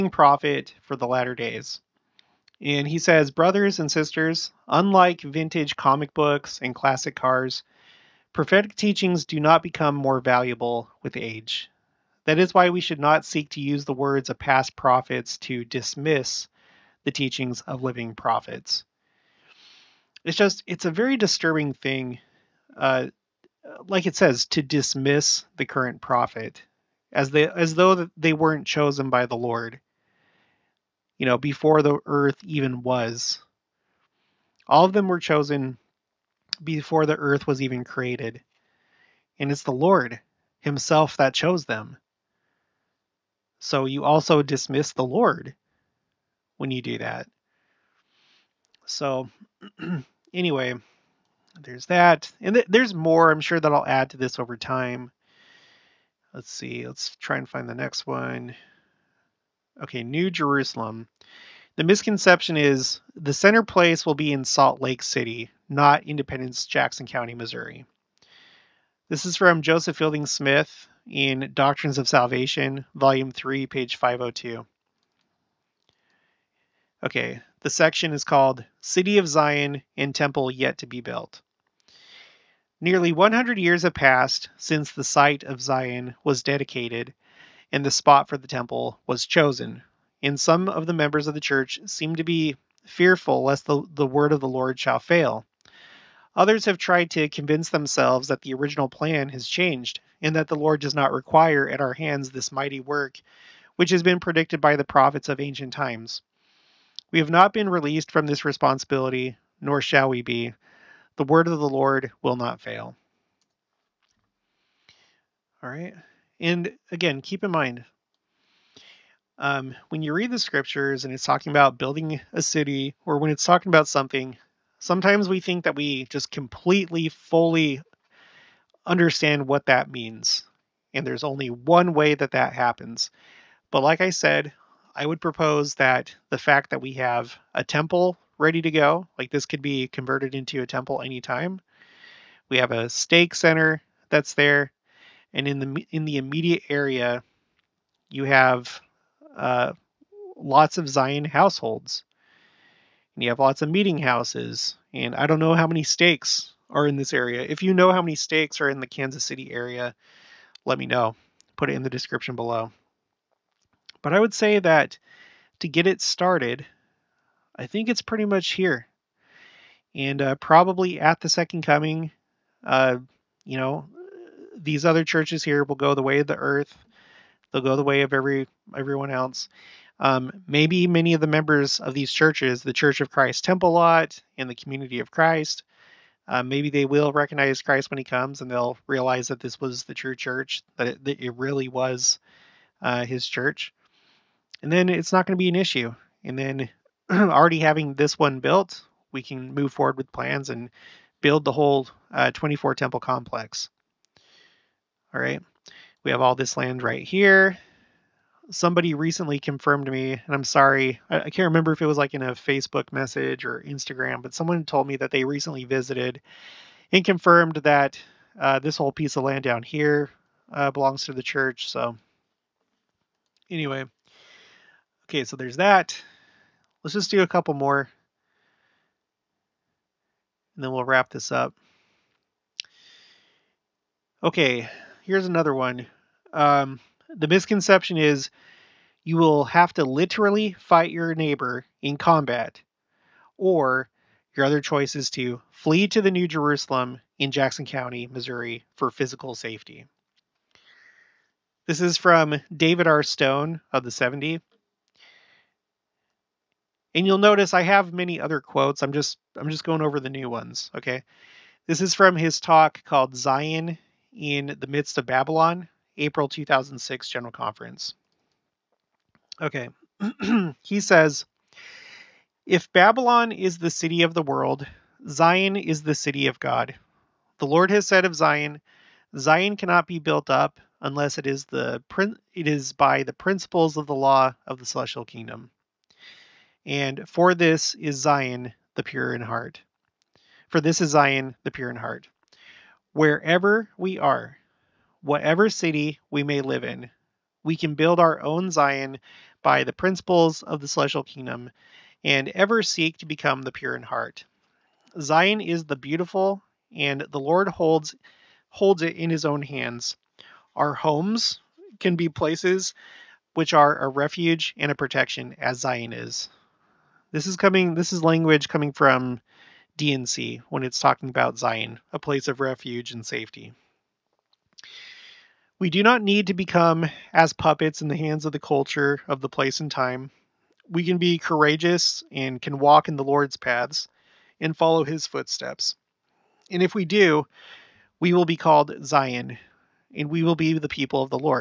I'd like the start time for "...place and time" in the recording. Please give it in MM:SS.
05:29.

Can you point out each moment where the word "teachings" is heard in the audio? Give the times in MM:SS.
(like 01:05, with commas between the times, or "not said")
00:08, 00:17.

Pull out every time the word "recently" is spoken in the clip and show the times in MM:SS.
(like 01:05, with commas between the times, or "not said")
03:28, 03:35.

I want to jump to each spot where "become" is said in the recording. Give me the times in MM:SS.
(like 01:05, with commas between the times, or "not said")
00:09, 05:03, 05:26.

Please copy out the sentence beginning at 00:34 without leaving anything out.
All of them were chosen before the earth was even created.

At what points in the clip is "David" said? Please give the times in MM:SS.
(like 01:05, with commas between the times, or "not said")
04:12.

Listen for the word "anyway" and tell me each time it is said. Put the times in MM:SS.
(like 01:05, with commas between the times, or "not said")
00:50, 03:43.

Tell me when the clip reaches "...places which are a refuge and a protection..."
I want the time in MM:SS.
05:12.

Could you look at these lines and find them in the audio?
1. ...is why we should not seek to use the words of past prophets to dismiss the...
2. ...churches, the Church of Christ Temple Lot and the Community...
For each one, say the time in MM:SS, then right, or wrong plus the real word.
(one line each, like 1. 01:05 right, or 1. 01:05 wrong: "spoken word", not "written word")
1. 00:12 right
2. 03:02 right.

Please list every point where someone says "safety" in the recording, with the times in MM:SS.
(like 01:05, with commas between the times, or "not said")
04:09, 05:23.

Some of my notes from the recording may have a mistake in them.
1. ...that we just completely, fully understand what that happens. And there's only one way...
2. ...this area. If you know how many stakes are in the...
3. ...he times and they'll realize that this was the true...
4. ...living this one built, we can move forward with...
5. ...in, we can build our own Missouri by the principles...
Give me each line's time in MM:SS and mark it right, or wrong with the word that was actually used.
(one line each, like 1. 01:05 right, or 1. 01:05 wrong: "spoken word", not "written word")
1. 02:05 wrong: "means", not "happens"
2. 02:36 right
3. 03:07 wrong: "comes", not "times"
4. 03:17 wrong: "having", not "living"
5. 04:56 wrong: "Zion", not "Missouri".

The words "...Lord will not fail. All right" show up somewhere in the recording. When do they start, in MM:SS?
01:51.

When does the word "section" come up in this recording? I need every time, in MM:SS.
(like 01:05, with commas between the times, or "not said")
01:17.